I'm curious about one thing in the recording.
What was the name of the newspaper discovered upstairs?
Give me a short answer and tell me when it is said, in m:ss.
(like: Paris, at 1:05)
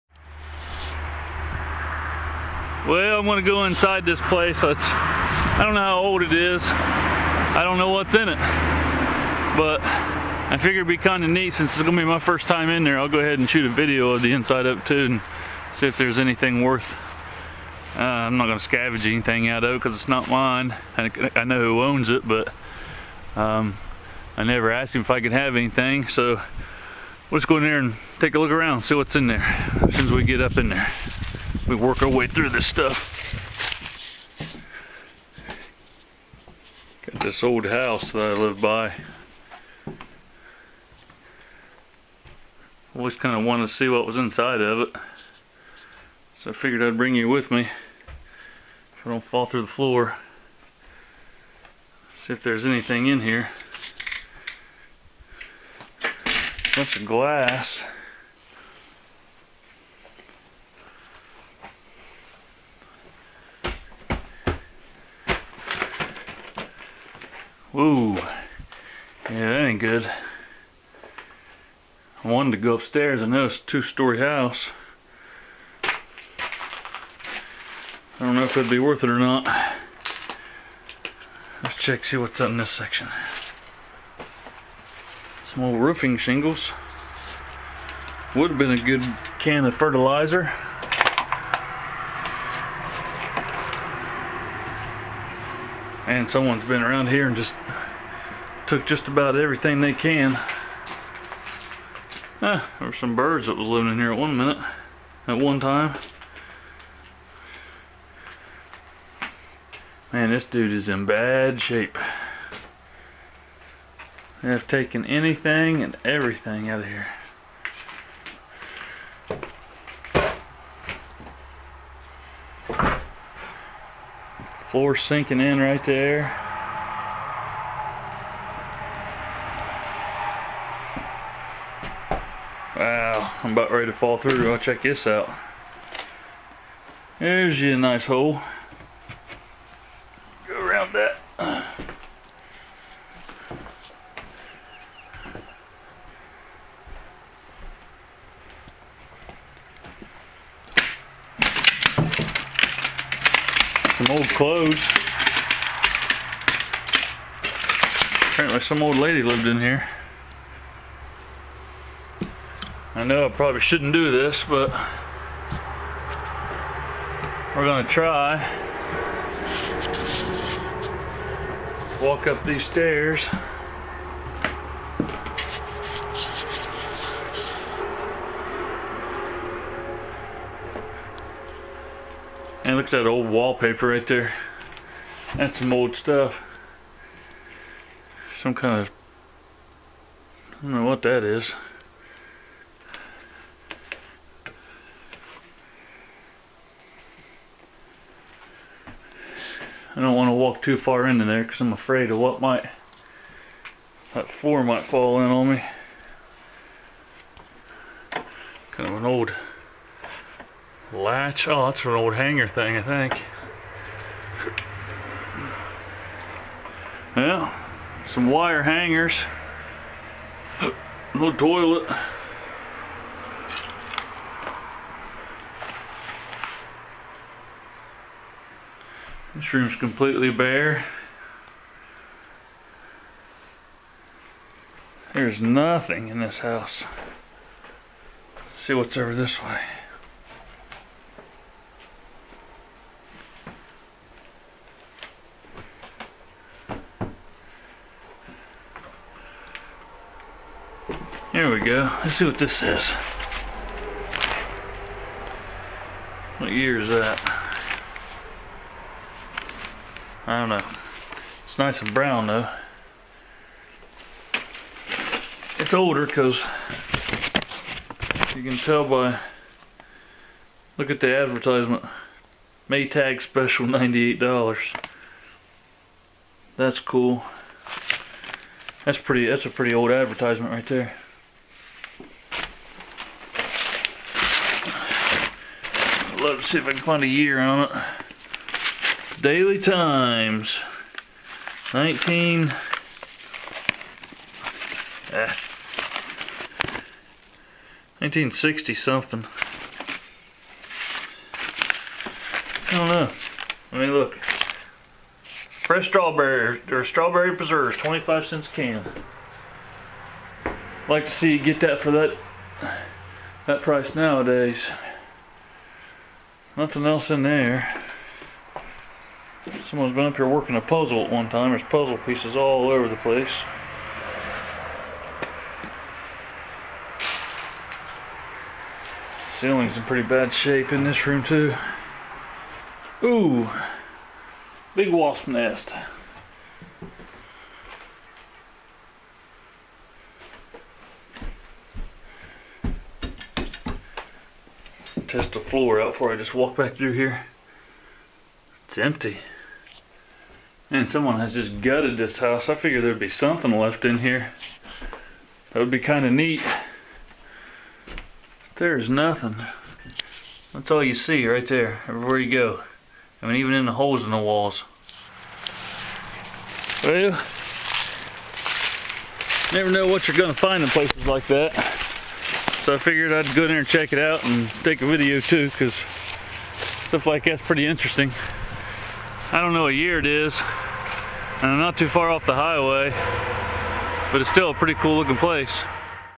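Daily Times, at 4:49.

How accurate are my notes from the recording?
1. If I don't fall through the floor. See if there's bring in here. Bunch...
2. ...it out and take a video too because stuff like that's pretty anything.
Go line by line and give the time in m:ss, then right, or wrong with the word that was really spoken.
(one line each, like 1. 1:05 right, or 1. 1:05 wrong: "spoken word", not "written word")
1. 0:47 wrong: "anything", not "bring"
2. 6:13 wrong: "interesting", not "anything".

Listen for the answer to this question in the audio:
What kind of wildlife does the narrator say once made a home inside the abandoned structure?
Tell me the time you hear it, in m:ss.
1:43.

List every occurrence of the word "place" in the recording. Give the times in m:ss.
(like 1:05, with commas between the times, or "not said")
0:04, 5:22, 6:10, 6:25.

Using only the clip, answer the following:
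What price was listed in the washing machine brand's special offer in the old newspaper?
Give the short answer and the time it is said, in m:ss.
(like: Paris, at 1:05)
$98, at 4:33.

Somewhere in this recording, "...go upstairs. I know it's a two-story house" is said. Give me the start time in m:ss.
1:12.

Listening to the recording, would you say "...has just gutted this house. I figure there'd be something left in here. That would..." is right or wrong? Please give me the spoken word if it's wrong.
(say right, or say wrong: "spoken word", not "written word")
right.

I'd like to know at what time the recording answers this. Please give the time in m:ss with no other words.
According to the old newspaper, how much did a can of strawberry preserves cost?
5:07.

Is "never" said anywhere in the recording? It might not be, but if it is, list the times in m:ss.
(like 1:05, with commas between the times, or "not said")
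0:24, 6:09.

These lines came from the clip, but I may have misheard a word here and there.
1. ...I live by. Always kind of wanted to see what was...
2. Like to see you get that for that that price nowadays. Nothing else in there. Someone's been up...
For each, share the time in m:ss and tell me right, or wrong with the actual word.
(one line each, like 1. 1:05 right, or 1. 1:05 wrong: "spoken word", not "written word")
1. 0:38 right
2. 5:10 right.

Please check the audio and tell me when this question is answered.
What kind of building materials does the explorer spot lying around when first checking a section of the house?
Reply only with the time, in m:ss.
1:25.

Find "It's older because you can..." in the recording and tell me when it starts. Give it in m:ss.
4:25.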